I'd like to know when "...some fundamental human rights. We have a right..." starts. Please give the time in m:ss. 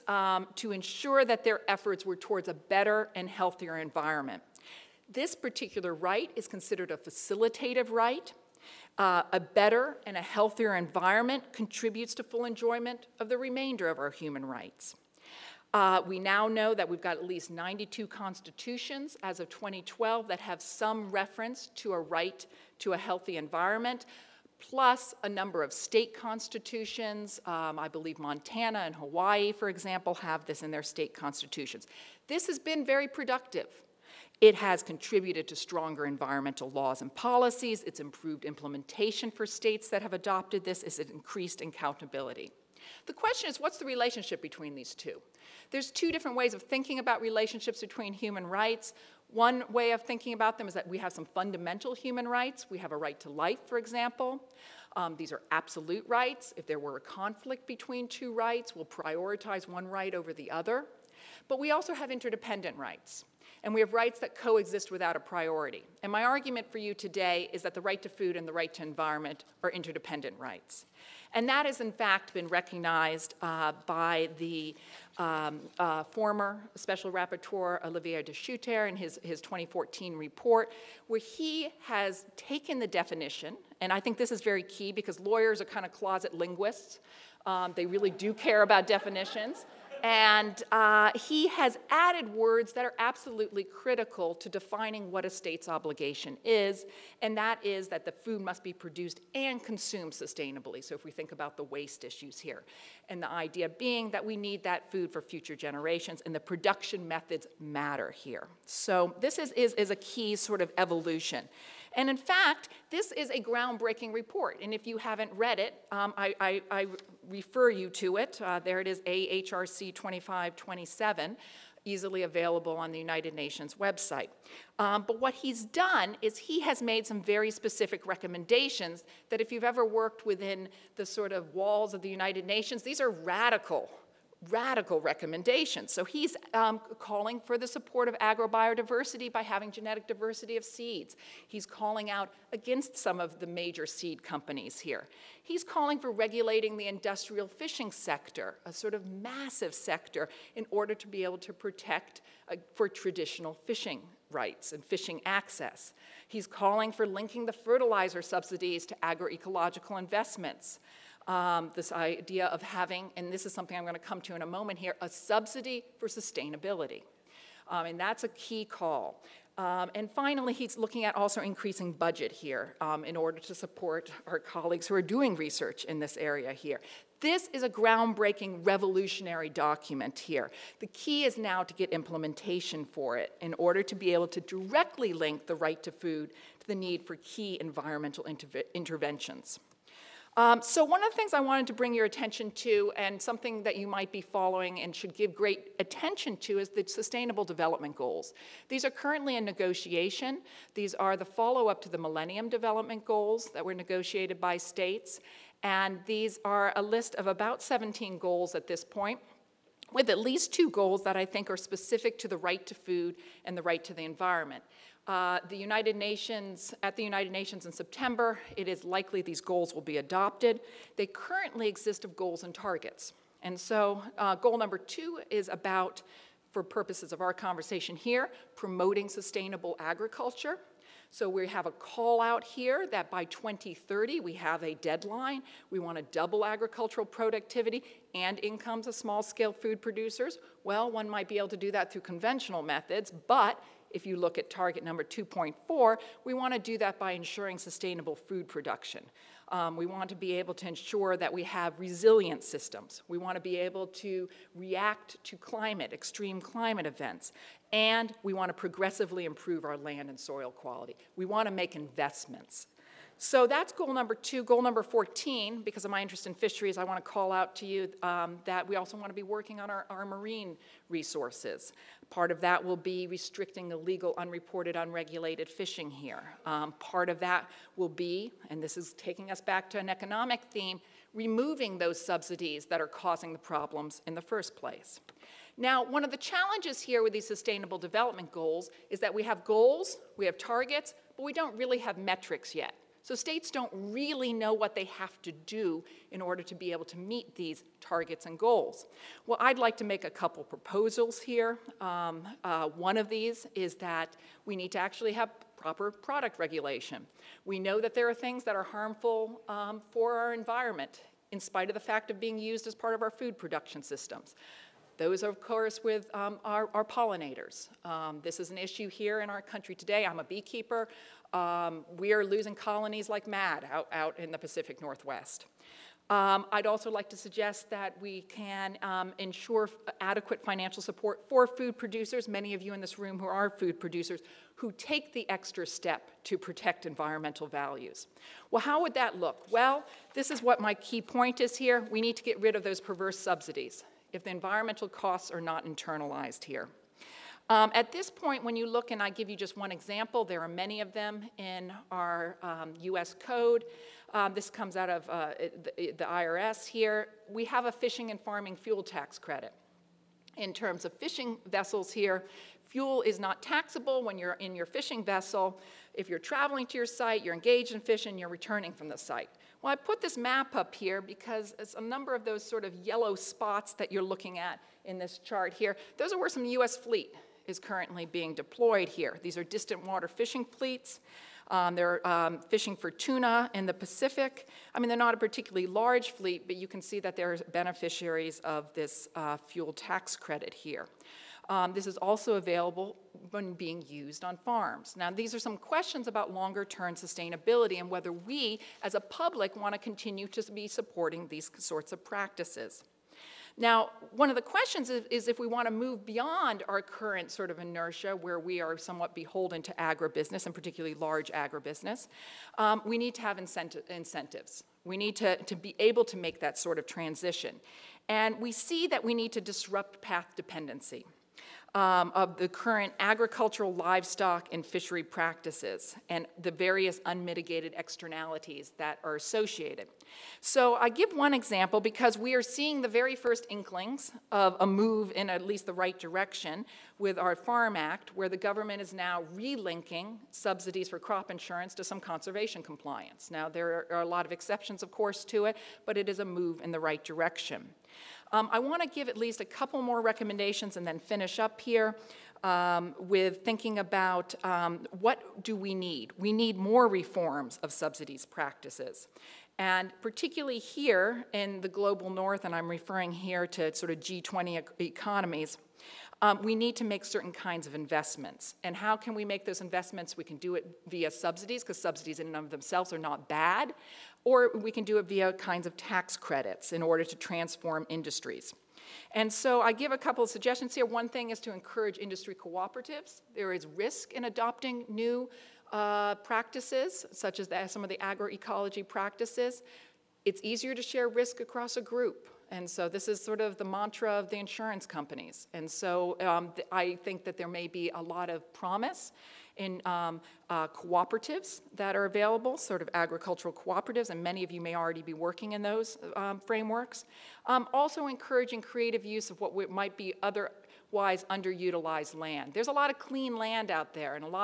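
0:51.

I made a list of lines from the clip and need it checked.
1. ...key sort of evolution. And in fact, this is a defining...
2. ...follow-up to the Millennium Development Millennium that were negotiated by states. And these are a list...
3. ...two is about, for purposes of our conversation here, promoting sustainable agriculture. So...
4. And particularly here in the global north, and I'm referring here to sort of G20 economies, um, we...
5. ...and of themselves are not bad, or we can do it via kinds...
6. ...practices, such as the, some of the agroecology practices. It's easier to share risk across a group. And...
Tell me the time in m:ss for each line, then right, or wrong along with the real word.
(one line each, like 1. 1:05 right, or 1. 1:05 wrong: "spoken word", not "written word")
1. 1:49 wrong: "groundbreaking", not "defining"
2. 3:21 wrong: "Goals", not "Millennium"
3. 3:44 right
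4. 7:39 right
5. 7:52 right
6. 8:06 right.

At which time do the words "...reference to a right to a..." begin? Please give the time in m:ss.
0:21.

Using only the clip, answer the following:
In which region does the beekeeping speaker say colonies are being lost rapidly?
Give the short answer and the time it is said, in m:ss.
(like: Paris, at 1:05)
Pacific Northwest, at 5:24.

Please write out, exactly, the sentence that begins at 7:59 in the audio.
And so I give a couple of suggestions here.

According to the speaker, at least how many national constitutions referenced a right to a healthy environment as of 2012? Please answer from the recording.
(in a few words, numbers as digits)
92.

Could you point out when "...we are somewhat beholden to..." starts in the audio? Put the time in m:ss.
6:48.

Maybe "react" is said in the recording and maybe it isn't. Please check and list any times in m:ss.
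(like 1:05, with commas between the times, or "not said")
4:14.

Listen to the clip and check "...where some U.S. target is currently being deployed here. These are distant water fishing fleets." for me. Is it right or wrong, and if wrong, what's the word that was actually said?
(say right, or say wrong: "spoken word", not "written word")
wrong: "fleet", not "target".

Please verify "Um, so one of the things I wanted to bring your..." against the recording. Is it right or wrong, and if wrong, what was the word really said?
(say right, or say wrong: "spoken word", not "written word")
right.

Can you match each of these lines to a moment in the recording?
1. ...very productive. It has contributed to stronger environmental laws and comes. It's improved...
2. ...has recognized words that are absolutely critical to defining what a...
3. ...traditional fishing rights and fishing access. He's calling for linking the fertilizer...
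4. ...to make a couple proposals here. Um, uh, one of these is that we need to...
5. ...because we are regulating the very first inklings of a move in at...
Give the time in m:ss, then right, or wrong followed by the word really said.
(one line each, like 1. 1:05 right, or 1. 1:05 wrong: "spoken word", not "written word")
1. 0:32 wrong: "policies", not "comes"
2. 1:31 wrong: "added", not "recognized"
3. 2:32 right
4. 4:59 right
5. 7:11 wrong: "seeing", not "regulating".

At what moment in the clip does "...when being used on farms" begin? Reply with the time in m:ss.
6:33.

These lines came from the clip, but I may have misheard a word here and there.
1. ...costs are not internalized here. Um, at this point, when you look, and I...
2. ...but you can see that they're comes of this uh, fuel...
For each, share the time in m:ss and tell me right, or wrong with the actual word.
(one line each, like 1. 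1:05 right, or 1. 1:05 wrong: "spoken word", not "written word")
1. 5:44 right
2. 6:26 wrong: "beneficiaries", not "comes".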